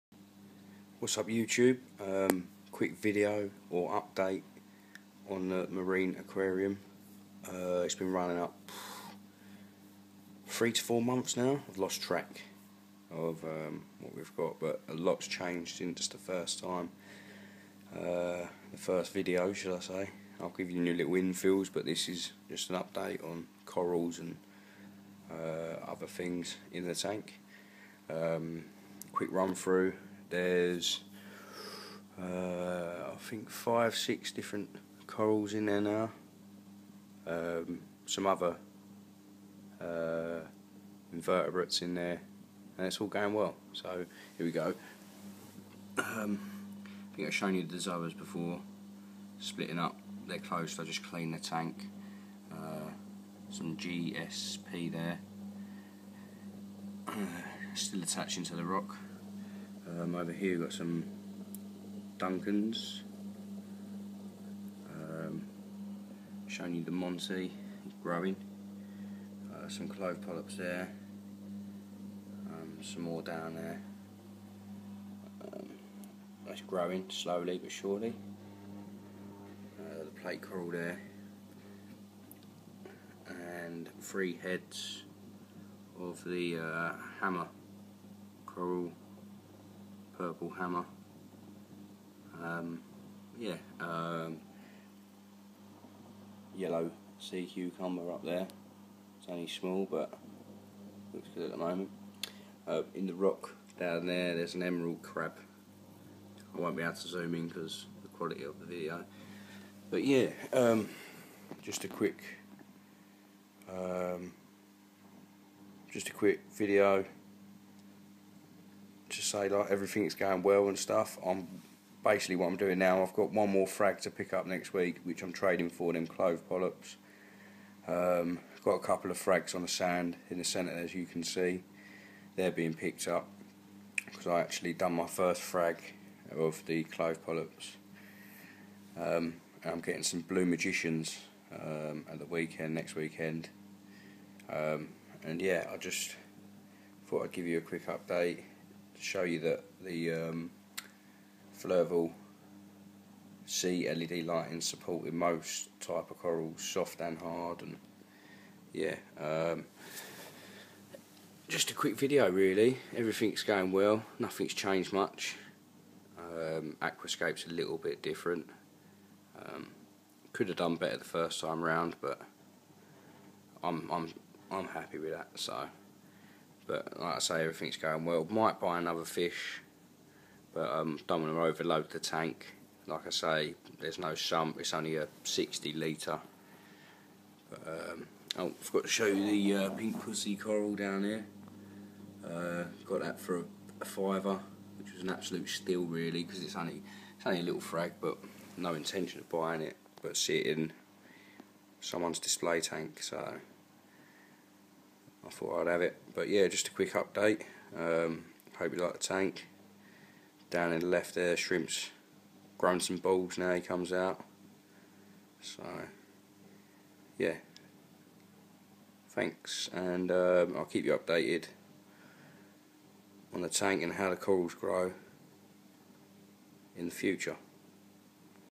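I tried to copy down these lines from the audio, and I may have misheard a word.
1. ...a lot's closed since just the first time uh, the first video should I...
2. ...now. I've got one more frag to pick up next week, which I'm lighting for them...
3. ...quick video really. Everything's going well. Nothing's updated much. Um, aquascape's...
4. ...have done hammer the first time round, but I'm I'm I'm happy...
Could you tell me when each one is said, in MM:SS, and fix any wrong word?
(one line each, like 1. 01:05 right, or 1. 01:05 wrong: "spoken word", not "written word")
1. 00:14 wrong: "changed", not "closed"
2. 02:02 wrong: "trading", not "lighting"
3. 02:41 wrong: "changed", not "updated"
4. 02:50 wrong: "better", not "hammer".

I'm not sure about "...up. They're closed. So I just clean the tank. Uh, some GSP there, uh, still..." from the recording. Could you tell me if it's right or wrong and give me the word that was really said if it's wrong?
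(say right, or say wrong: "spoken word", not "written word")
right.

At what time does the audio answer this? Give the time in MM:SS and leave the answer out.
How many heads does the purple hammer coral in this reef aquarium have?
01:23.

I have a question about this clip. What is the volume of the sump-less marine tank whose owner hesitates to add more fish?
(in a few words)
60 litres.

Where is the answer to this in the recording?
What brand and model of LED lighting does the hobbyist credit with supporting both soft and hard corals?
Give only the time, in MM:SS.
02:31.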